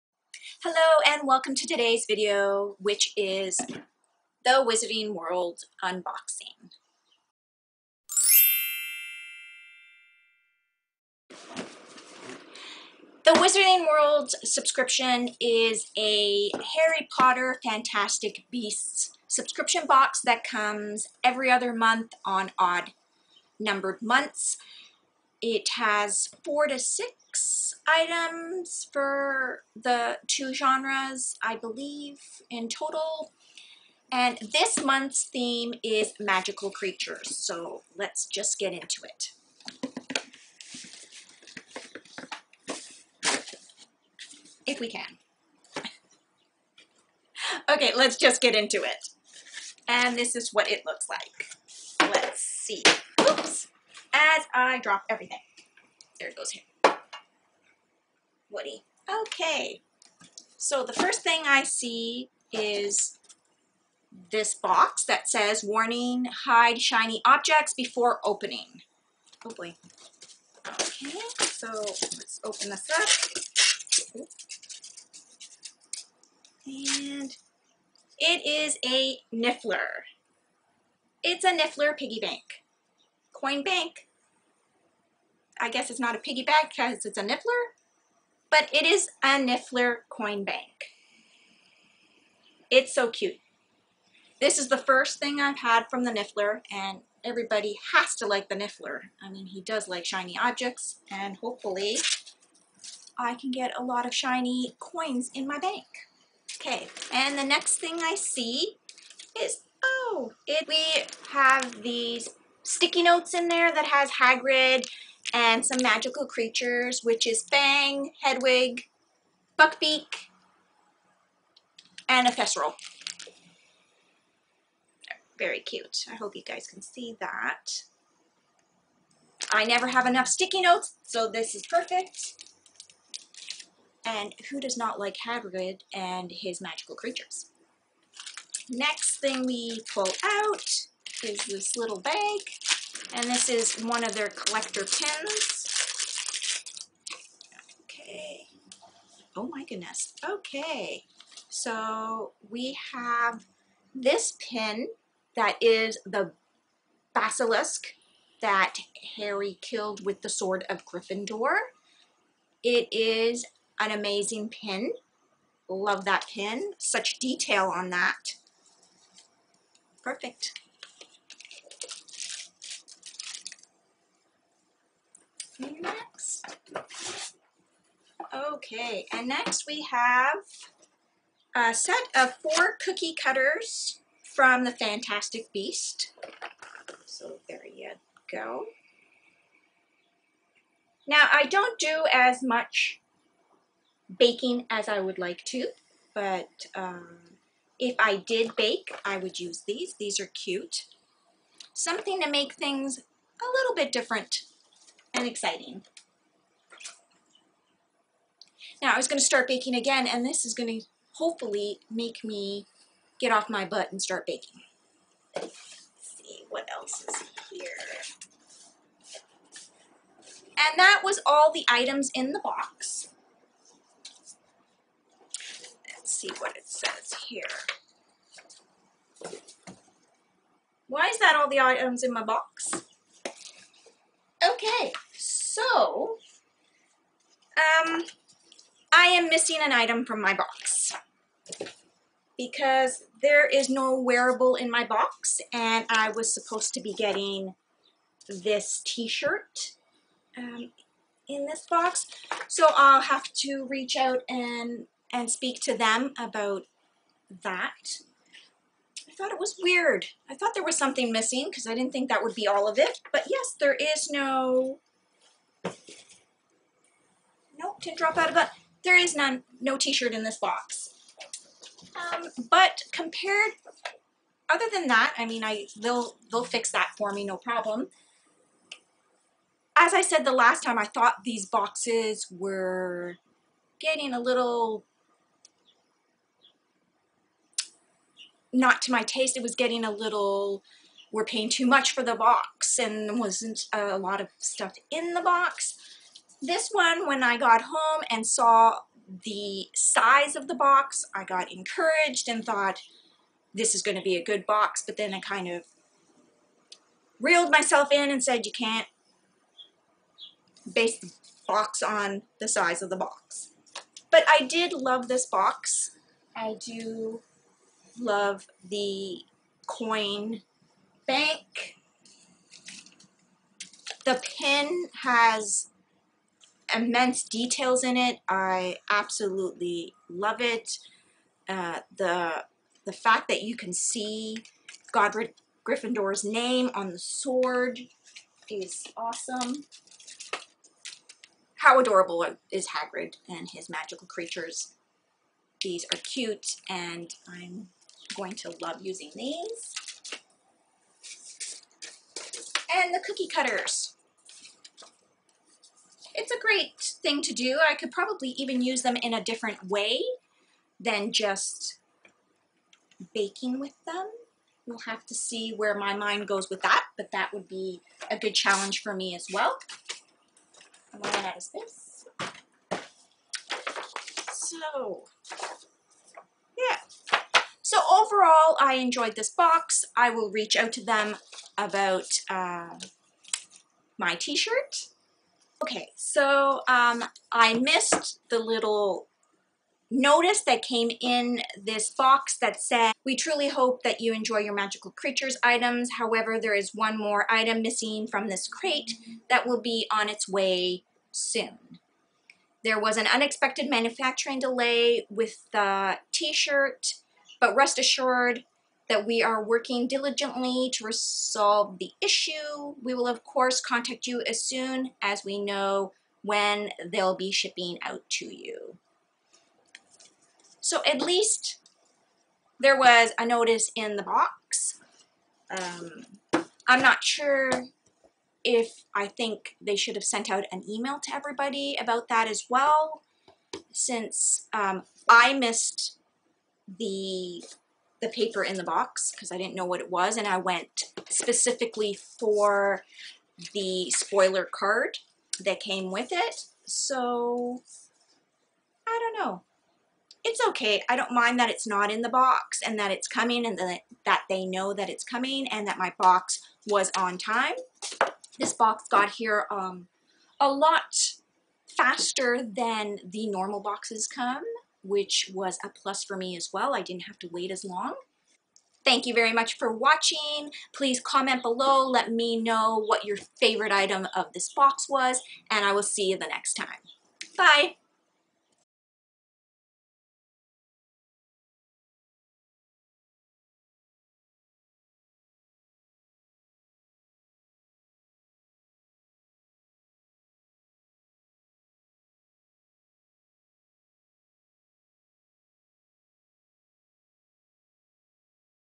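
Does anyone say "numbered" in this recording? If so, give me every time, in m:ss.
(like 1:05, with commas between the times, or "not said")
0:23.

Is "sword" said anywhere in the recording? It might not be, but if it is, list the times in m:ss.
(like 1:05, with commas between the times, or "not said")
2:40, 5:36.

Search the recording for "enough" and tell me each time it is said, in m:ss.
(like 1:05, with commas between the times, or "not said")
2:10.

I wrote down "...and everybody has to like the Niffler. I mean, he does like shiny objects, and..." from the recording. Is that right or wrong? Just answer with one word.
right.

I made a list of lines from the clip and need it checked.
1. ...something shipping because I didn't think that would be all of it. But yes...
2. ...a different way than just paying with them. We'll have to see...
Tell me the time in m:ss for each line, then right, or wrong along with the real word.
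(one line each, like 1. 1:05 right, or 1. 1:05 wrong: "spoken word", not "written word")
1. 4:20 wrong: "missing", not "shipping"
2. 5:59 wrong: "baking", not "paying".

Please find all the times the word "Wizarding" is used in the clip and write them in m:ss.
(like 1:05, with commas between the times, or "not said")
0:04, 0:13.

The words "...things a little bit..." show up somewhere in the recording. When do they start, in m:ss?
3:22.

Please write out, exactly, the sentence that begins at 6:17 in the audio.
So overall, I enjoyed this box.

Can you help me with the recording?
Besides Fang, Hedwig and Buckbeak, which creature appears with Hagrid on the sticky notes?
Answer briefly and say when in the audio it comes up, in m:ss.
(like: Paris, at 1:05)
Thestral, at 2:02.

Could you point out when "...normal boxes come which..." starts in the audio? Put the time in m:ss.
7:43.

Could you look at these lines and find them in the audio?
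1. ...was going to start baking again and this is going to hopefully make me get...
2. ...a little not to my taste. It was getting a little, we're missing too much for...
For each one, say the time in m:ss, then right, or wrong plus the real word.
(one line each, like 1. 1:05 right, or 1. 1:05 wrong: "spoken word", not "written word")
1. 3:28 right
2. 4:44 wrong: "paying", not "missing".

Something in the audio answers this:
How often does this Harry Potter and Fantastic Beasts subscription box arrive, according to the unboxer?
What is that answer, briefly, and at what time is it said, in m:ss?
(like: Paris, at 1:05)
Every other month, at 0:21.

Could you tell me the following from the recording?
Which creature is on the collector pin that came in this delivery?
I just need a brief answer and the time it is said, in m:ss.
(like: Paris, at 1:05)
Basilisk, at 2:37.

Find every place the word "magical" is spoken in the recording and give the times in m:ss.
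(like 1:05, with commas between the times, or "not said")
0:36, 1:55, 2:16, 5:43, 6:34.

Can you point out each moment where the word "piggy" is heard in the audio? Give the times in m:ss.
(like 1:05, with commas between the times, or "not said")
1:21, 1:26.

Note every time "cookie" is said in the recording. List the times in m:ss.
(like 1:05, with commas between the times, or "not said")
3:02, 5:53.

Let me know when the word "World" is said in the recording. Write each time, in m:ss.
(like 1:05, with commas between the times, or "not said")
0:05, 0:13.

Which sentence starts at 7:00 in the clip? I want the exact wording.
So at least there was a notice in the box.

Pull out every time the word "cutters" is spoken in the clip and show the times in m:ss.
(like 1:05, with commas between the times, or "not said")
3:03, 5:53.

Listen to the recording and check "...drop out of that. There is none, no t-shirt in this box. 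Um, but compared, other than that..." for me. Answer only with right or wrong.
right.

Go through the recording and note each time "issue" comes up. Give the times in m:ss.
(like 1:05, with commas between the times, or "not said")
6:51.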